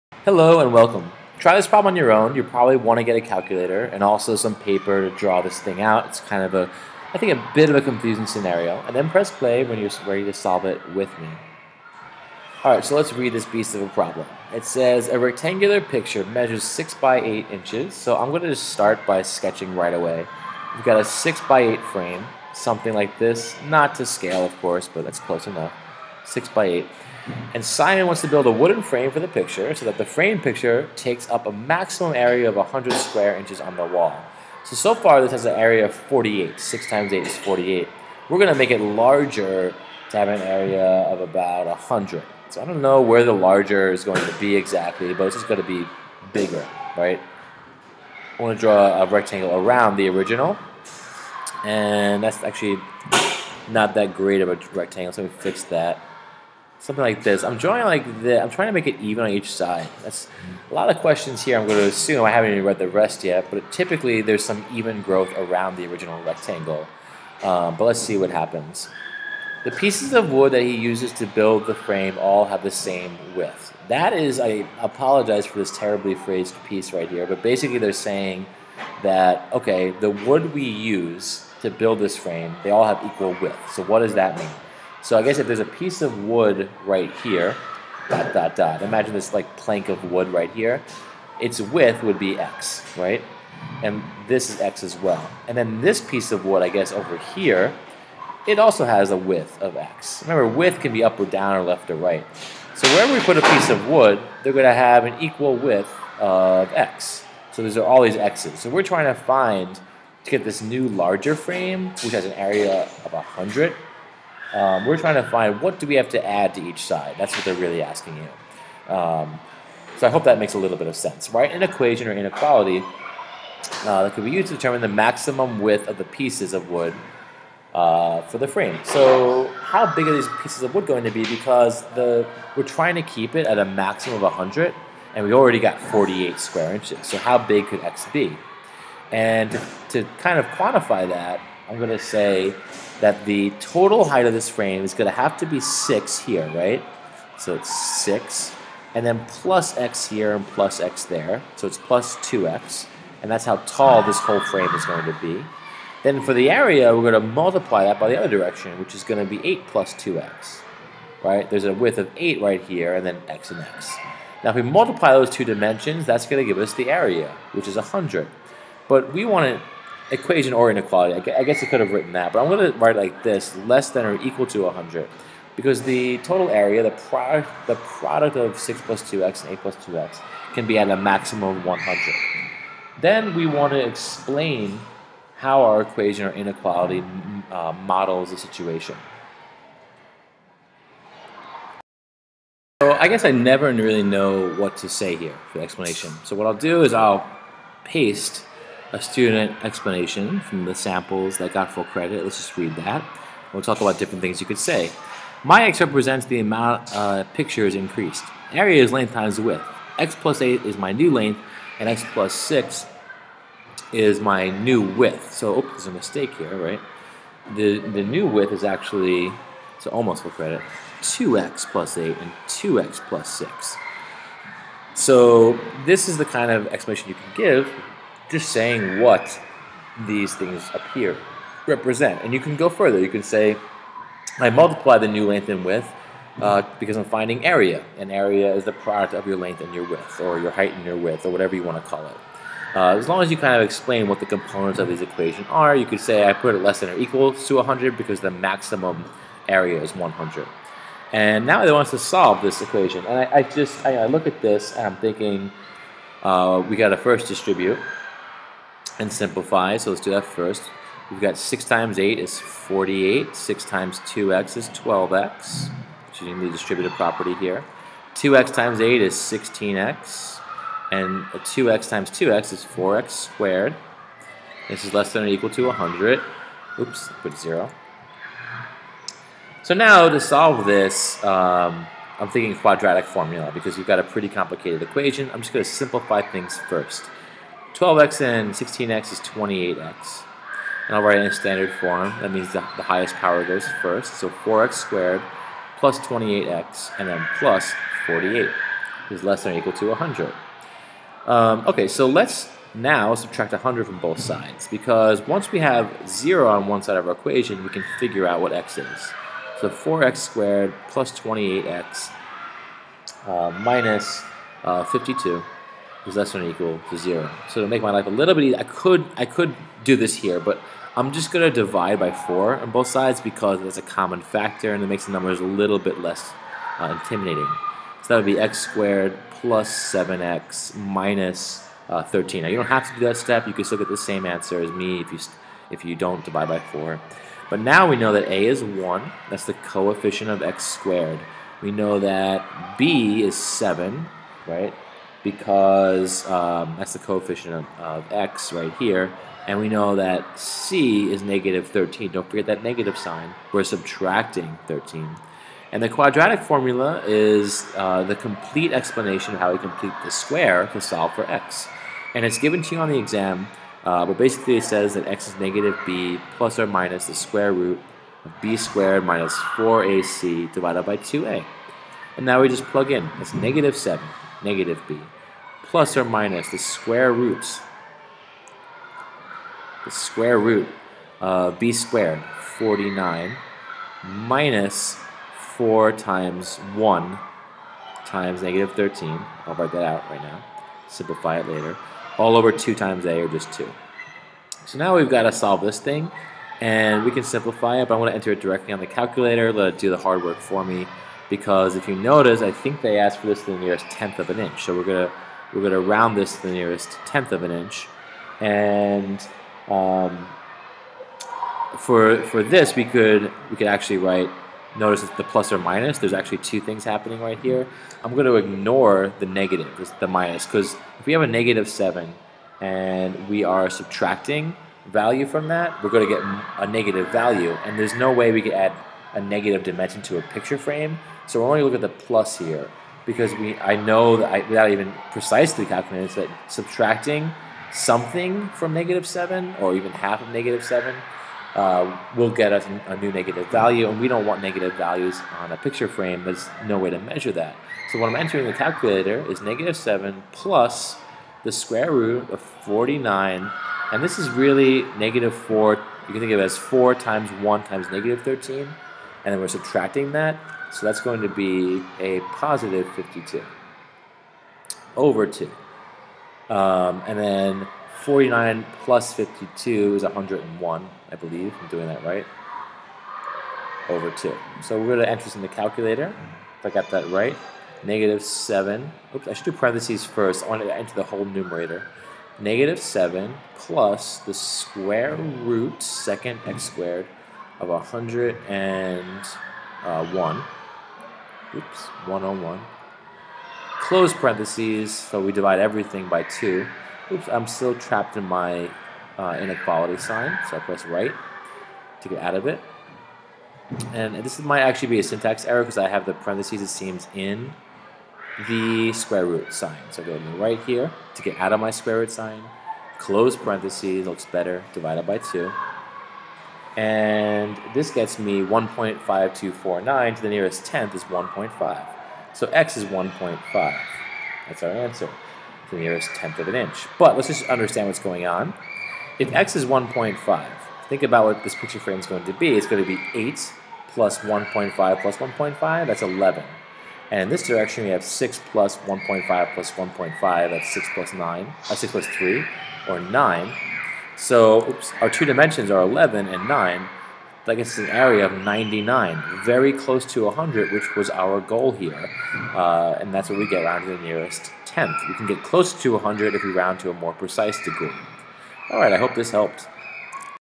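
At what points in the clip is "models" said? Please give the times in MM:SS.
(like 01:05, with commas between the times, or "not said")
03:07.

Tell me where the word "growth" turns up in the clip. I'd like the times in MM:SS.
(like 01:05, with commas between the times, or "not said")
01:05.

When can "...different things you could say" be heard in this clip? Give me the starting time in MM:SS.
03:23.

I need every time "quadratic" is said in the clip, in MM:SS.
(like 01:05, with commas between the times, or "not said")
04:42, 05:55.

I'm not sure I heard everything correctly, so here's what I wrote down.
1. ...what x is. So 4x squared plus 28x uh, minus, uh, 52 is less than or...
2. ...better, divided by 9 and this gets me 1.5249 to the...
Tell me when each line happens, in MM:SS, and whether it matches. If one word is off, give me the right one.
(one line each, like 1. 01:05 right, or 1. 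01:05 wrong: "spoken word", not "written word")
1. 05:08 right
2. 08:34 wrong: "2", not "9".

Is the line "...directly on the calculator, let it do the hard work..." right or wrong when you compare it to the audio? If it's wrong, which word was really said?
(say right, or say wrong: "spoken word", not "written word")
right.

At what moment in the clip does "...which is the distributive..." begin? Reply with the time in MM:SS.
04:26.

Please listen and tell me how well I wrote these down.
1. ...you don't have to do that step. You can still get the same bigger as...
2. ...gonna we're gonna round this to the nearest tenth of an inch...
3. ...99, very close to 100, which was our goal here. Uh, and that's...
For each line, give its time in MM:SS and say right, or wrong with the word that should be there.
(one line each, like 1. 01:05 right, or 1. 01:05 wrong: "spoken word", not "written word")
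1. 05:32 wrong: "answer", not "bigger"
2. 06:44 right
3. 09:08 right.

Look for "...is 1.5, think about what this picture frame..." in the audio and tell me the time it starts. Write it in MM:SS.
08:49.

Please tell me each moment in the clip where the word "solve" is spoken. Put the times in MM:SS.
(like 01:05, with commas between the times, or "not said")
00:10, 04:11, 04:40, 06:00, 06:35.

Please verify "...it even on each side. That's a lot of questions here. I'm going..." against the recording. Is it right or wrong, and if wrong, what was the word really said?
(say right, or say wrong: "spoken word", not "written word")
right.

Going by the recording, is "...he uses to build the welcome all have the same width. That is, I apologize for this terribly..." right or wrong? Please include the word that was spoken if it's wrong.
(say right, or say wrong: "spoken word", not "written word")
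wrong: "frame", not "welcome".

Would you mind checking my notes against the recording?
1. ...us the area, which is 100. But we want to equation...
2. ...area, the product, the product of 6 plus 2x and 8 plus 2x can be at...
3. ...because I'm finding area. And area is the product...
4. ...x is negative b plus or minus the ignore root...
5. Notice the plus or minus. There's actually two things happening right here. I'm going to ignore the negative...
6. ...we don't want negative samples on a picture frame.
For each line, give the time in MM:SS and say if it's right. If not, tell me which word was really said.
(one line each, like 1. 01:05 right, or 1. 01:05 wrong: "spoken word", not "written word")
1. 02:46 right
2. 02:56 right
3. 03:56 right
4. 06:05 wrong: "square", not "ignore"
5. 06:54 right
6. 07:23 wrong: "values", not "samples".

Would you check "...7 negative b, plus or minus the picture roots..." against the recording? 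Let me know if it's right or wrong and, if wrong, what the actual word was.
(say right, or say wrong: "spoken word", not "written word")
wrong: "square", not "picture".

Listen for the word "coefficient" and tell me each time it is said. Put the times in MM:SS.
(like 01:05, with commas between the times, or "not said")
05:39, 05:46.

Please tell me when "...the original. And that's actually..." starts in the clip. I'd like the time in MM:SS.
00:49.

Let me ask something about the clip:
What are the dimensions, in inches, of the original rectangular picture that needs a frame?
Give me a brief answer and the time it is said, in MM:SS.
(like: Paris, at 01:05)
6 by 8, at 00:16.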